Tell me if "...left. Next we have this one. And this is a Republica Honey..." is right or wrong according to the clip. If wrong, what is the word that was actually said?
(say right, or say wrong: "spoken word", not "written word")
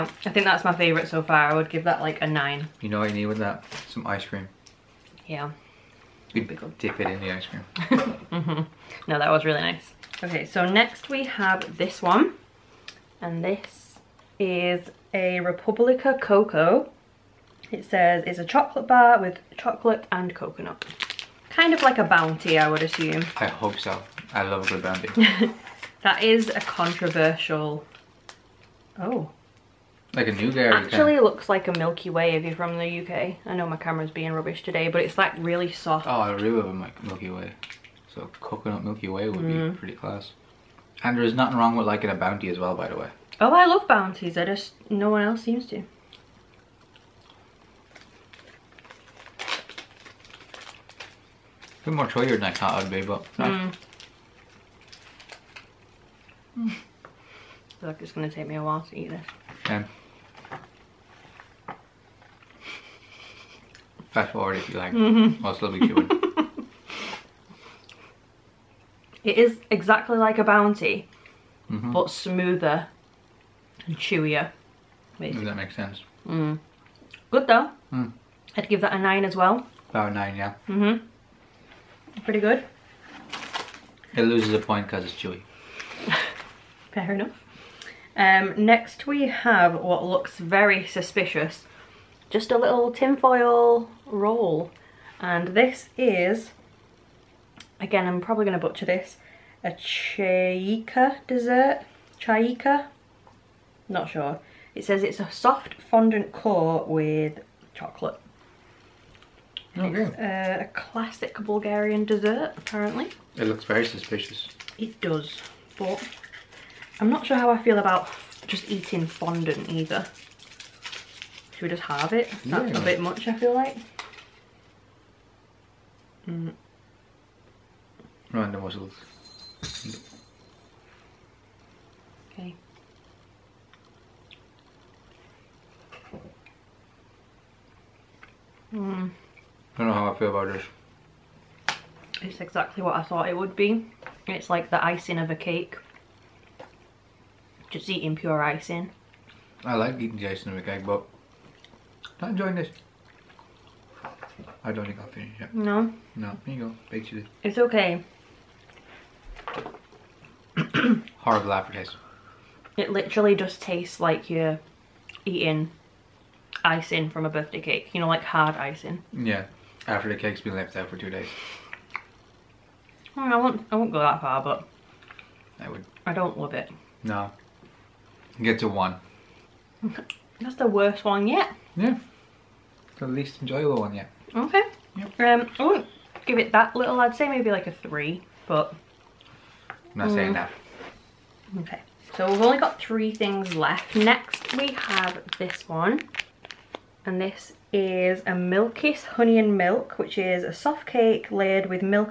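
wrong: "Milkiss", not "Republica".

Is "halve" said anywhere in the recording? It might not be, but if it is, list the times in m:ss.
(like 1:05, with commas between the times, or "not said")
2:01.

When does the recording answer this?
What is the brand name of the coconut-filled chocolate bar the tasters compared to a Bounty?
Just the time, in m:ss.
0:15.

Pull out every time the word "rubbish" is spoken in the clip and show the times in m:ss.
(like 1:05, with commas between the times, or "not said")
0:34.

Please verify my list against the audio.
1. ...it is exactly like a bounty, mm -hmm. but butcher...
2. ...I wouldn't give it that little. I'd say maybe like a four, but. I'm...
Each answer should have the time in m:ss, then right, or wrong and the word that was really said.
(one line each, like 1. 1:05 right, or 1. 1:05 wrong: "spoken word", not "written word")
1. 1:09 wrong: "smoother", not "butcher"
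2. 3:05 wrong: "three", not "four".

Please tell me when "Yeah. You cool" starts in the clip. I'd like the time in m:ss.
0:05.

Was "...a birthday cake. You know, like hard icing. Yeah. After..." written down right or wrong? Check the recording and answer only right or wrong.
right.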